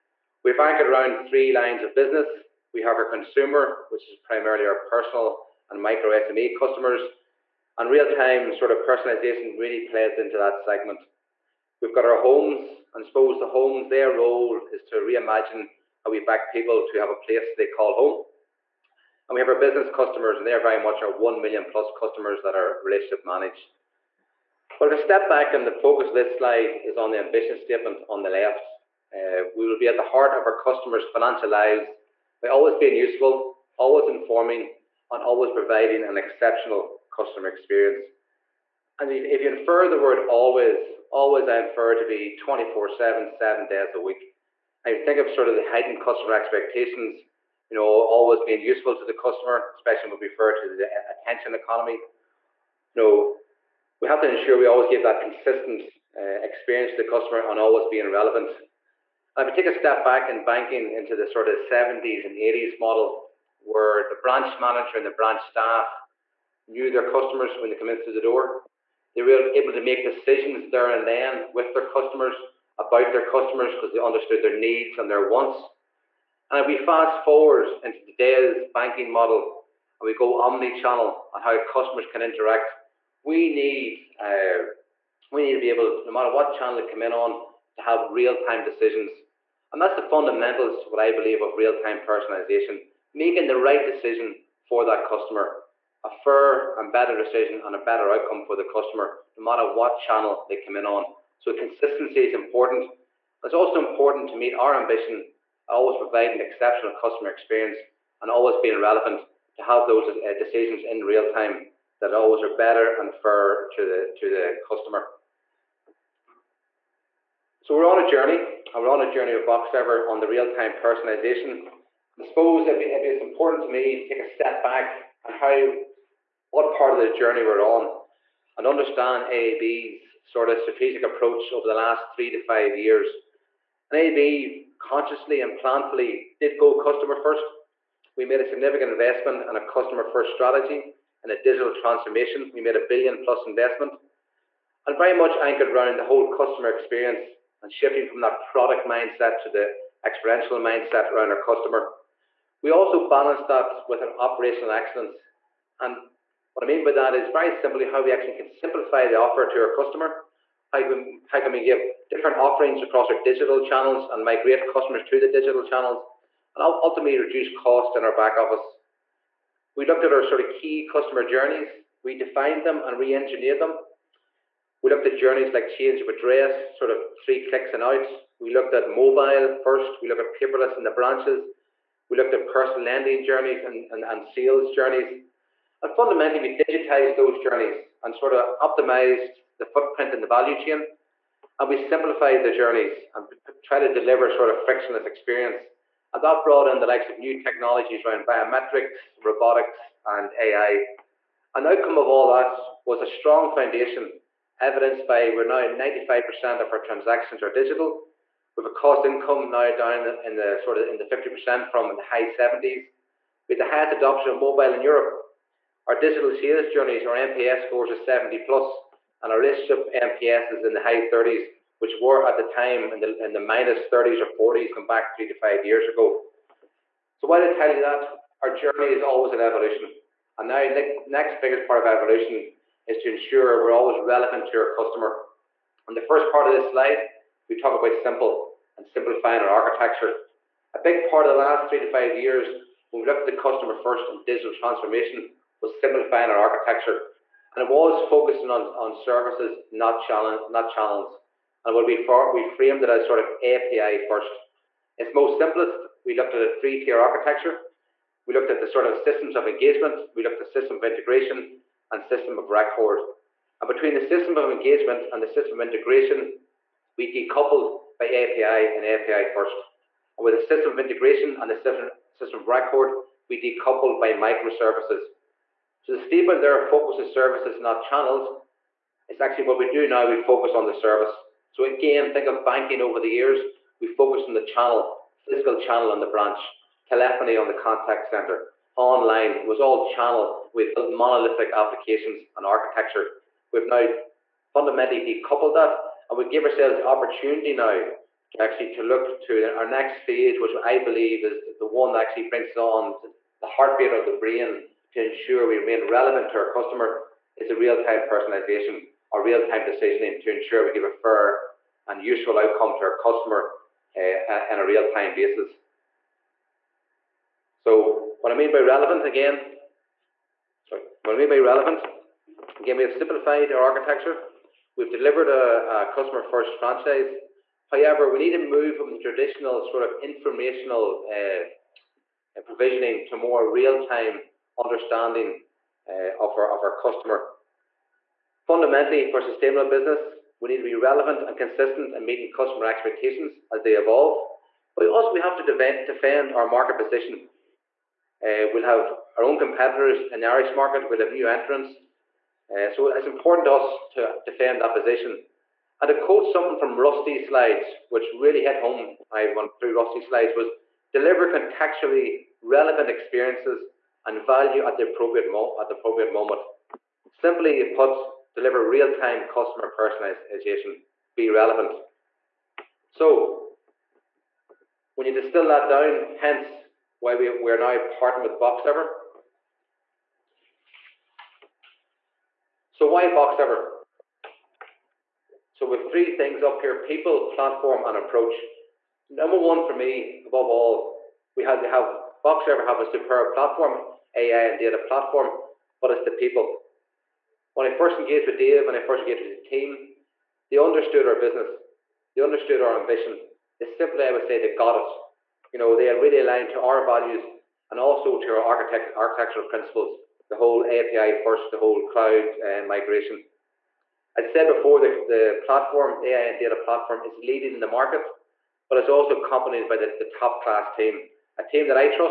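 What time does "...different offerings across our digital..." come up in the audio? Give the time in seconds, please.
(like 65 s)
162 s.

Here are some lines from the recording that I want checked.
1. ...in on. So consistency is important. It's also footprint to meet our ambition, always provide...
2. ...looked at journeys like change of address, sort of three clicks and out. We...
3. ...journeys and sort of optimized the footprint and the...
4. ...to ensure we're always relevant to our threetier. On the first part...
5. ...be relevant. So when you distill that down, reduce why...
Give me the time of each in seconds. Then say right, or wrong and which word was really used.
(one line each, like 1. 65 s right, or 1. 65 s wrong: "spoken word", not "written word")
1. 100 s wrong: "important", not "footprint"
2. 174 s right
3. 187 s right
4. 232 s wrong: "customer", not "threetier"
5. 371 s wrong: "hence", not "reduce".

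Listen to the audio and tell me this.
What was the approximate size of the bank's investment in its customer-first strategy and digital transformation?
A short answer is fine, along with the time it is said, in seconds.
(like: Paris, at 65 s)
a billion plus, at 142 s.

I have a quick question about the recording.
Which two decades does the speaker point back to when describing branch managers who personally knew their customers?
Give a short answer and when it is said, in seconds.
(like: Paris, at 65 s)
70s and 80s, at 61 s.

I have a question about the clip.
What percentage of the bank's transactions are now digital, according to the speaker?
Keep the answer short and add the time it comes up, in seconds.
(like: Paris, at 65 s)
95%, at 205 s.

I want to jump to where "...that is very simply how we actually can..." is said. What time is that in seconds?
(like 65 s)
156 s.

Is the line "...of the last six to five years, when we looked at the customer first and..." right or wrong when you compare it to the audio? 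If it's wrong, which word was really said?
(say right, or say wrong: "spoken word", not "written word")
wrong: "three", not "six".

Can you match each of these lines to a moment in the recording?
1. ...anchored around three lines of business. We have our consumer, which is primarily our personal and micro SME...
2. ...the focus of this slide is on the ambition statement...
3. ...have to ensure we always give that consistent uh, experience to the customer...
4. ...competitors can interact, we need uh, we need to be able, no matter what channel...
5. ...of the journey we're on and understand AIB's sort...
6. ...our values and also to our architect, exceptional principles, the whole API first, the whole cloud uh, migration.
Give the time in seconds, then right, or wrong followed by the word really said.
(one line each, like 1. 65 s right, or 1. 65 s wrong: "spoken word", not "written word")
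1. 0 s right
2. 25 s right
3. 54 s right
4. 81 s wrong: "customers", not "competitors"
5. 126 s right
6. 406 s wrong: "architectural", not "exceptional".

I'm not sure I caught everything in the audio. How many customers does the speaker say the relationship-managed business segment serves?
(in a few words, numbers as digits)
1 million plus.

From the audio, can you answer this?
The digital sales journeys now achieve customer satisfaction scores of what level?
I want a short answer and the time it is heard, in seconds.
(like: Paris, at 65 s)
70 plus, at 217 s.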